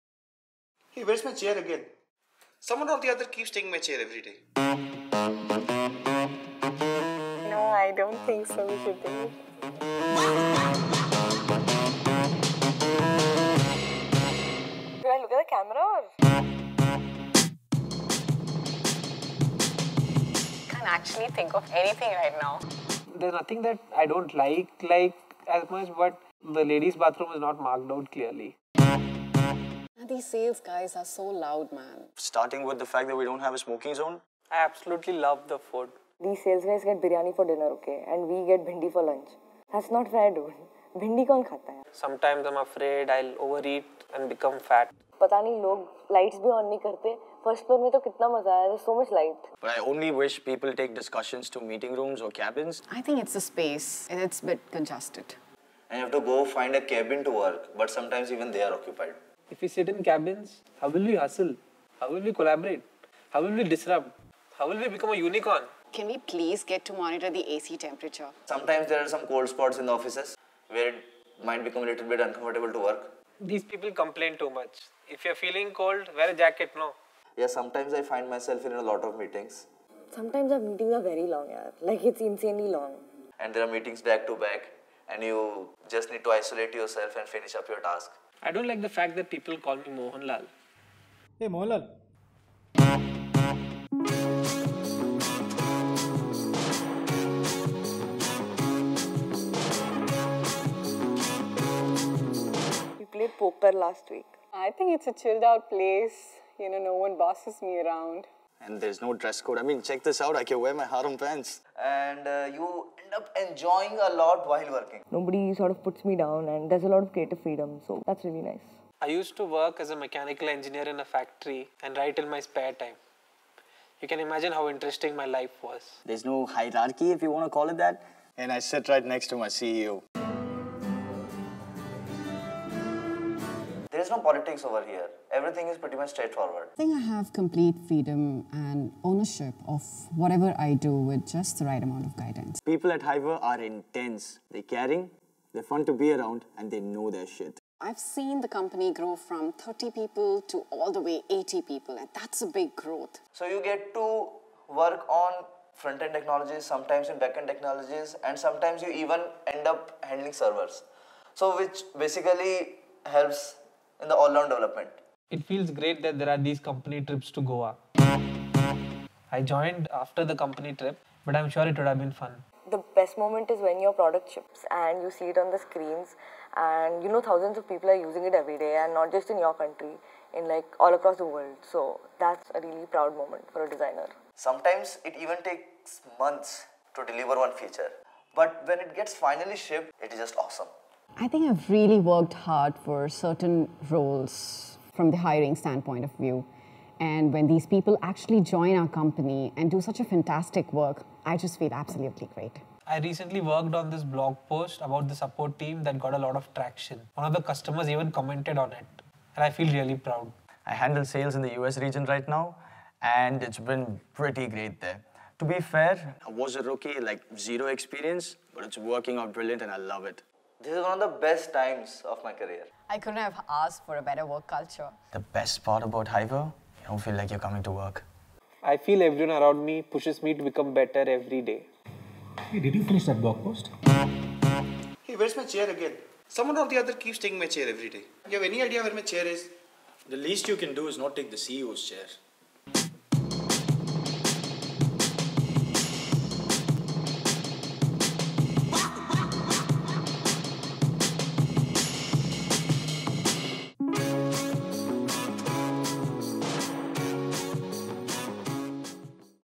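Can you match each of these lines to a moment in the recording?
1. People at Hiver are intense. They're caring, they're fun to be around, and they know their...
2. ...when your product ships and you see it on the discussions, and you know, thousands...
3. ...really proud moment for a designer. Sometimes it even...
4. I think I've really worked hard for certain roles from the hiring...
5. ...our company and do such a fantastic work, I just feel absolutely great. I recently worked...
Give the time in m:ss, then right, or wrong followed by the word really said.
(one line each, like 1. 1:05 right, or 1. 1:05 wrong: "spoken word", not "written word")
1. 2:22 right
2. 2:53 wrong: "screens", not "discussions"
3. 3:02 right
4. 3:11 right
5. 3:18 right.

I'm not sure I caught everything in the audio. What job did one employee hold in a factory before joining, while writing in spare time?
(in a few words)
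Mechanical engineer.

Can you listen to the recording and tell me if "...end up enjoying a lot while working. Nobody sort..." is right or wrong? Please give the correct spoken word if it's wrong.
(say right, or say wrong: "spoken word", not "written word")
right.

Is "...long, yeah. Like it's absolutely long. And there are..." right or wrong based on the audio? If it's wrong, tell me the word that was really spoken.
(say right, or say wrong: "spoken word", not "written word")
wrong: "insanely", not "absolutely".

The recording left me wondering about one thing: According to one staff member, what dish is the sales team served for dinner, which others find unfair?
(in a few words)
Biryani.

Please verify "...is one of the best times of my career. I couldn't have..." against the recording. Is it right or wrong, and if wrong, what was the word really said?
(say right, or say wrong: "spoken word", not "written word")
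right.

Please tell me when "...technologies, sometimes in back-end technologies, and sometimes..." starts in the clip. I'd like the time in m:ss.
2:36.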